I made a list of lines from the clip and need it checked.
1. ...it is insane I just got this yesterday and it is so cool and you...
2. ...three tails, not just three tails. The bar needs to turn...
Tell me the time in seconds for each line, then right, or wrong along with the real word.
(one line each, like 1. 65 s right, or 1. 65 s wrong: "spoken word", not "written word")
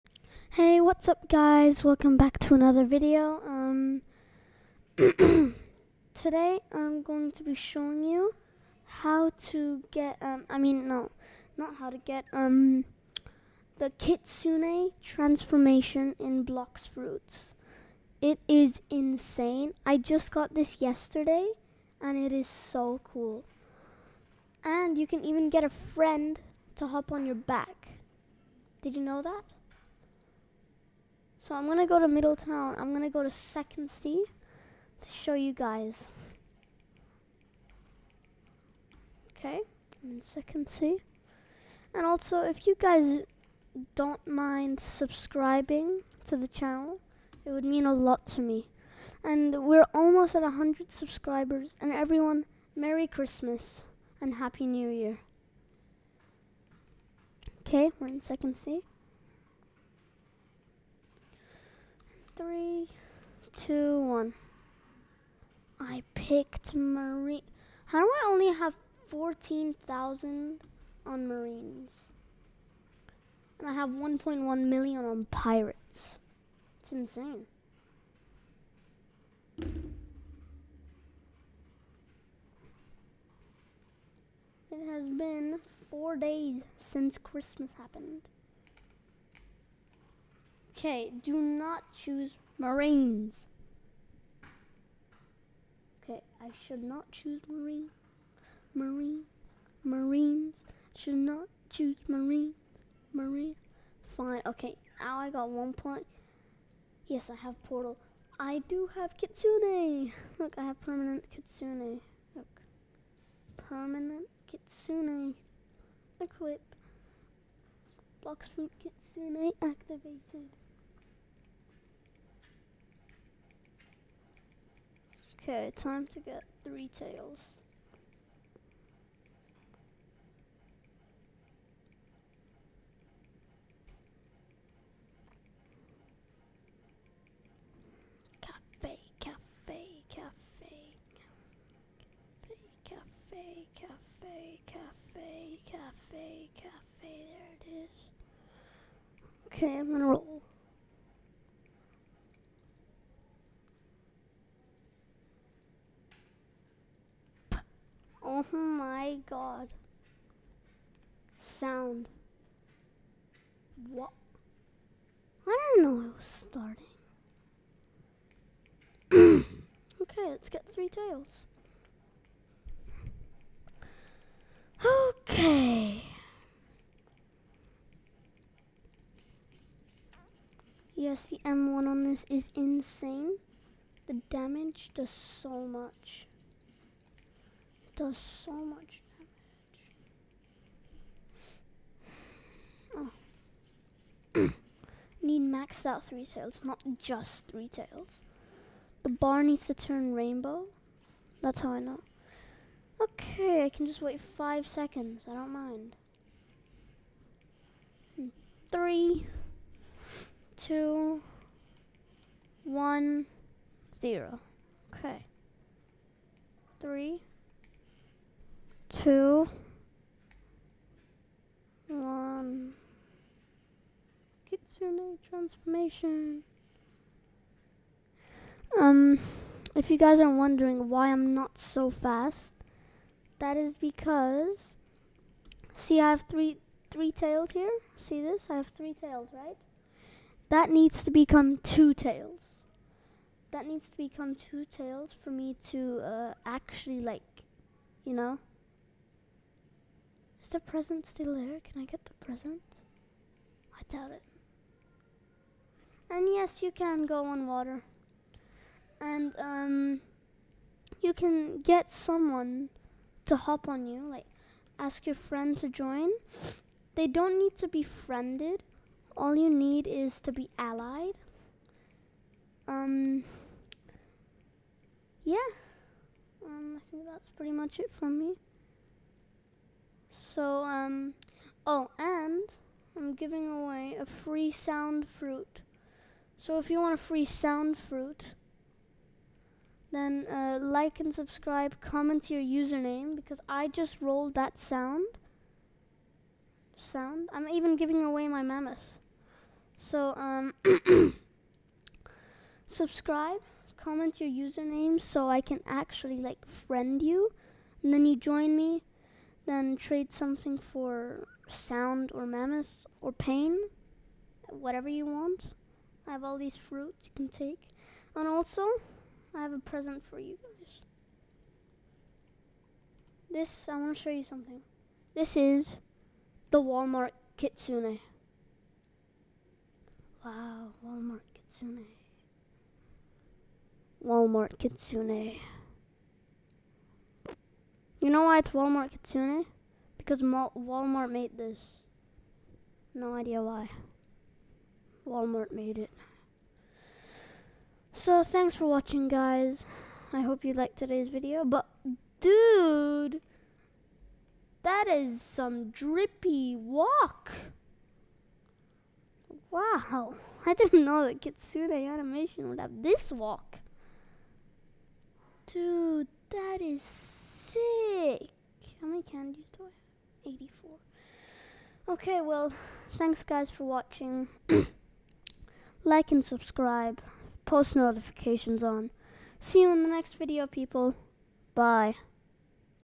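1. 18 s right
2. 196 s right.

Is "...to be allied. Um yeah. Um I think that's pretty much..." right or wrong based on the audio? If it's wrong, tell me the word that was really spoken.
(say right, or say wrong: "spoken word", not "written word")
right.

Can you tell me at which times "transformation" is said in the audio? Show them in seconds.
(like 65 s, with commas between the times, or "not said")
15 s, 225 s.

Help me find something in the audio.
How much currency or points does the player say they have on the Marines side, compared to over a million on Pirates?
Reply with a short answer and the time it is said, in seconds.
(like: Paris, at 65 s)
14,000, at 69 s.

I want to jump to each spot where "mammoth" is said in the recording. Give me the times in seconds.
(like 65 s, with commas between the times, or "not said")
298 s, 312 s.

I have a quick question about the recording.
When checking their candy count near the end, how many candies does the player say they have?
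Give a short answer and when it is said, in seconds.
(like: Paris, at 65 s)
84, at 370 s.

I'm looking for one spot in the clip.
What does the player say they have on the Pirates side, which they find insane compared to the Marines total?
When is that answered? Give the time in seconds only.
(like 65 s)
73 s.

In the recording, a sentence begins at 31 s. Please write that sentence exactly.
So I'm going to go to Middletown.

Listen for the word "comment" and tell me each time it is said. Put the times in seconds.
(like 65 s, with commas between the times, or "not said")
291 s, 303 s.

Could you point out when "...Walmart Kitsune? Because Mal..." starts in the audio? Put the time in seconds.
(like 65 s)
338 s.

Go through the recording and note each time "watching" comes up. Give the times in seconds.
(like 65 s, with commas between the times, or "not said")
348 s, 373 s.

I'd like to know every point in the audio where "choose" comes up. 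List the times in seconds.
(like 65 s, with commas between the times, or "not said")
91 s, 97 s, 101 s.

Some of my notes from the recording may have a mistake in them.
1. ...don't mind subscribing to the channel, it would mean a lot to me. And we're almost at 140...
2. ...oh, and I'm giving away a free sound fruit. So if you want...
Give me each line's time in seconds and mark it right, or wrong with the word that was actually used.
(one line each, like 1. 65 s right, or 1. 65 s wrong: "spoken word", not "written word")
1. 43 s wrong: "100", not "140"
2. 281 s right.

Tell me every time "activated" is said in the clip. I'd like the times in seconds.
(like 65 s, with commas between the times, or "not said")
119 s.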